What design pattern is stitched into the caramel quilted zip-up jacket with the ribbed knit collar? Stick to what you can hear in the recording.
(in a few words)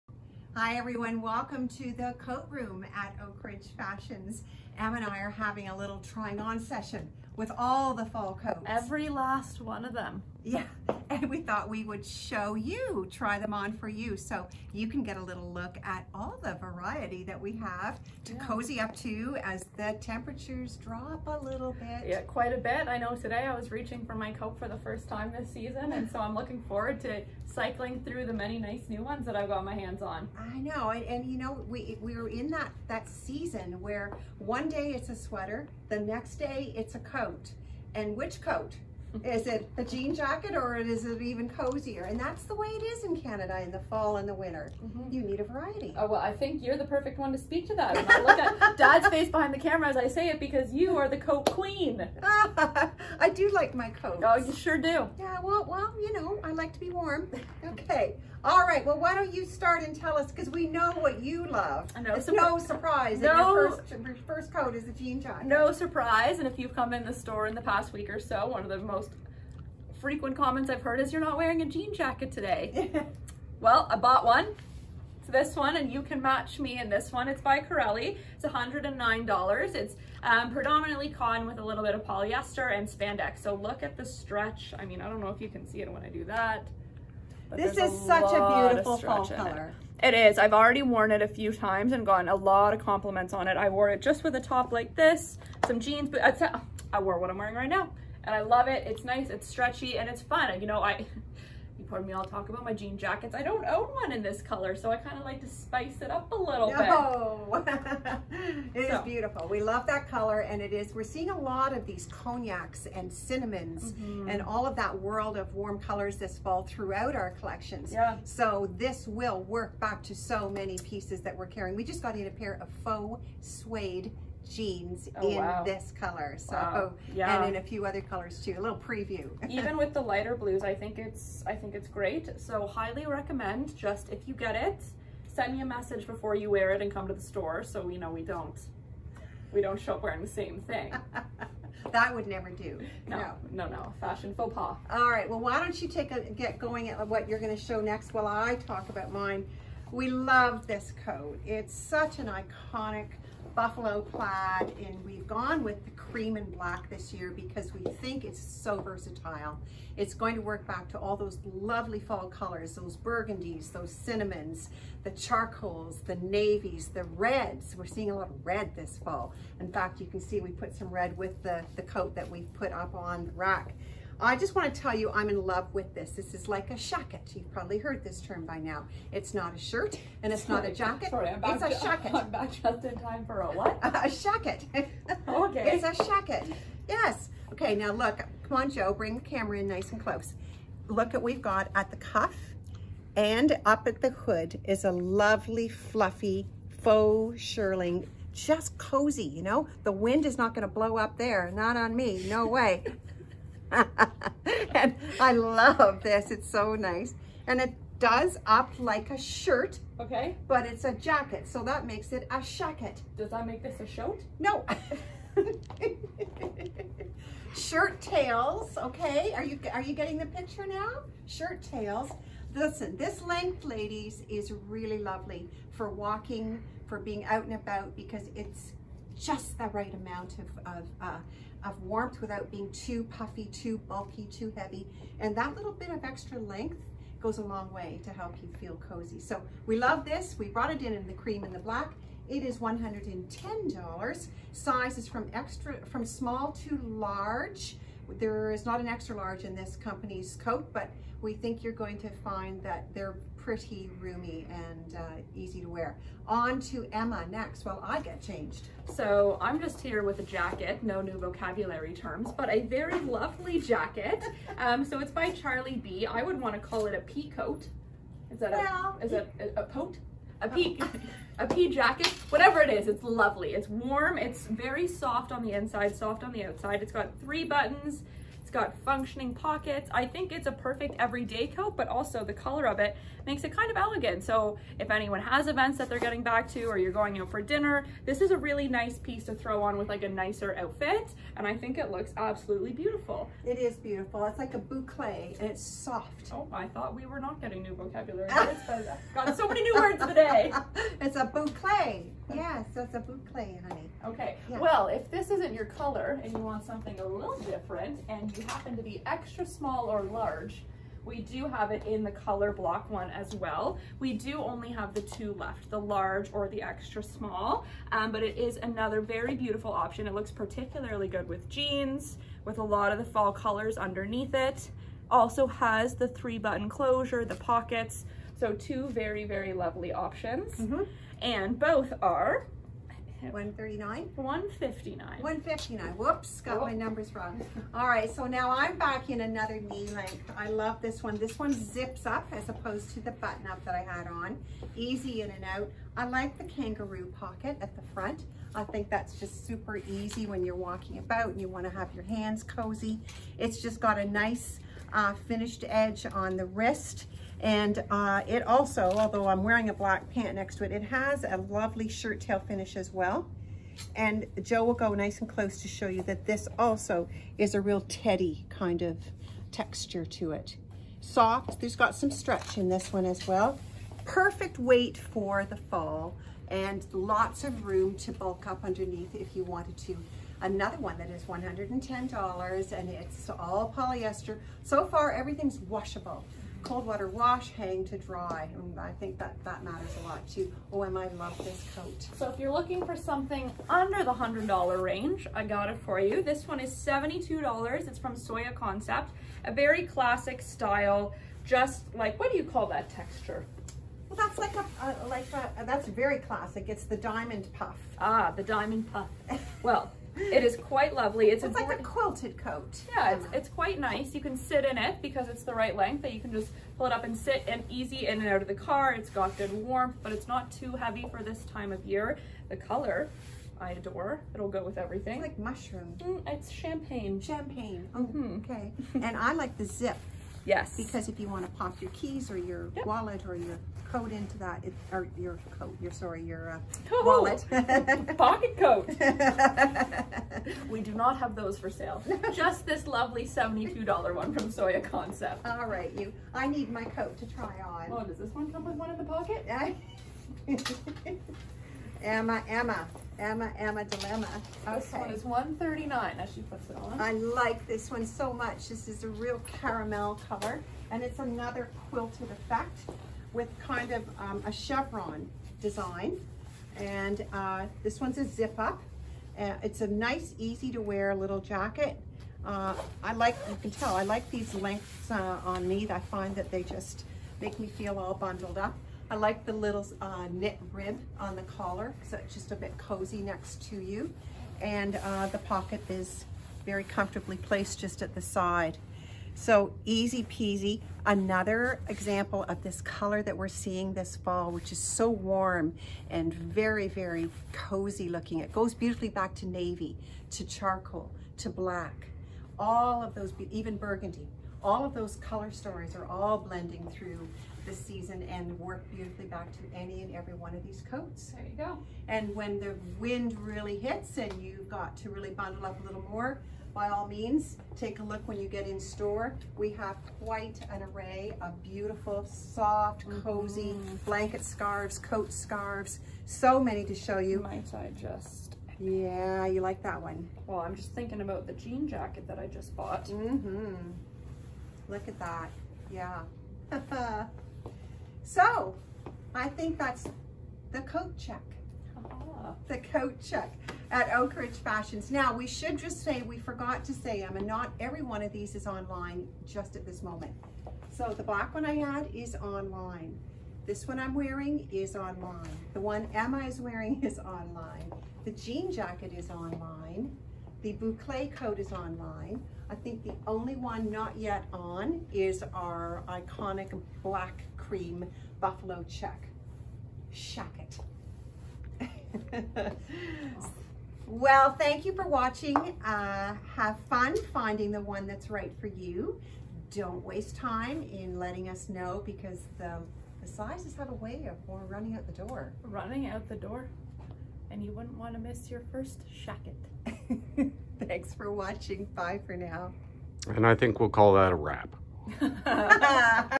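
chevron.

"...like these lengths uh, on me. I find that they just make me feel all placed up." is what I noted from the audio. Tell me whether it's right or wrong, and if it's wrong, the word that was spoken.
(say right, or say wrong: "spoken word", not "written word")
wrong: "bundled", not "placed".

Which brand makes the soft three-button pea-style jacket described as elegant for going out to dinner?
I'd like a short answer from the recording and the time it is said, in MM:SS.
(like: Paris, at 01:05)
Charlie B, at 04:25.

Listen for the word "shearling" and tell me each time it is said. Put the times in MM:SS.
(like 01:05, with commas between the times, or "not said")
03:17.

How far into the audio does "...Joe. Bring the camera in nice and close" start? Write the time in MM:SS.
03:08.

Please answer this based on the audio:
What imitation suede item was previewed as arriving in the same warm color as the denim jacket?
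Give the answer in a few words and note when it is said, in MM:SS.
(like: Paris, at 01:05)
faux suede jeans, at 02:02.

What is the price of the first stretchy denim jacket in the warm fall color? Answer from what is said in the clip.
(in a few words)
$109.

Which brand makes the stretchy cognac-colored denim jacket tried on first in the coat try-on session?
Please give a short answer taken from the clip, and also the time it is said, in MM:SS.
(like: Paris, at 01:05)
Corelli, at 01:17.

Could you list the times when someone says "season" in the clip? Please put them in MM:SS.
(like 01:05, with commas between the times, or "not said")
00:25, 00:33, 08:27.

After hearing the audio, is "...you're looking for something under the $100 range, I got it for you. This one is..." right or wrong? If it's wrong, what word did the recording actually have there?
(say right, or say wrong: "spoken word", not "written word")
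right.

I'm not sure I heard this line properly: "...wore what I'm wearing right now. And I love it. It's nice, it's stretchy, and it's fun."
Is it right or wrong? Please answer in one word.
right.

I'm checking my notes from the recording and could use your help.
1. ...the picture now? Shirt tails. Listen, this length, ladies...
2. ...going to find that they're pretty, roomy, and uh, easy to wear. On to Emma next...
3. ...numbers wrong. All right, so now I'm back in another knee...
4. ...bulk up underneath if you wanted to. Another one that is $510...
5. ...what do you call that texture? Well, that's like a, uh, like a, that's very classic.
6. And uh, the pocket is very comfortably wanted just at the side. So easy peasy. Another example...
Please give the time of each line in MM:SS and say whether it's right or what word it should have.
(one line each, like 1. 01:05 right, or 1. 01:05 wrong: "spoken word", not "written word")
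1. 03:40 right
2. 04:11 right
3. 05:36 right
4. 06:18 wrong: "110", not "510"
5. 06:42 right
6. 08:04 wrong: "placed", not "wanted".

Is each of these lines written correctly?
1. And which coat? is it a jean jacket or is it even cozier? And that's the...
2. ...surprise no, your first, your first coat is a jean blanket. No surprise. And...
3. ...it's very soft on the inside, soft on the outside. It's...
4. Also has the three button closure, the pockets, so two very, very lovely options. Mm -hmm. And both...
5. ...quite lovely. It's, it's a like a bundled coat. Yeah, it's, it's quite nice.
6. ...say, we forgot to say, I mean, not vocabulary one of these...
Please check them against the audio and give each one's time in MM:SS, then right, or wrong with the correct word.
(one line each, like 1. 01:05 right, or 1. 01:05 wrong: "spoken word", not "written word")
1. 00:37 right
2. 01:02 wrong: "jacket", not "blanket"
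3. 04:34 right
4. 05:25 right
5. 06:50 wrong: "quilted", not "bundled"
6. 09:06 wrong: "every", not "vocabulary".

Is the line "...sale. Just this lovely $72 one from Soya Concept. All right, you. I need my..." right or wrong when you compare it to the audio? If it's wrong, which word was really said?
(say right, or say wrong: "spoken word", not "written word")
right.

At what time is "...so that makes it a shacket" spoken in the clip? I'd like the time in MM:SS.
03:31.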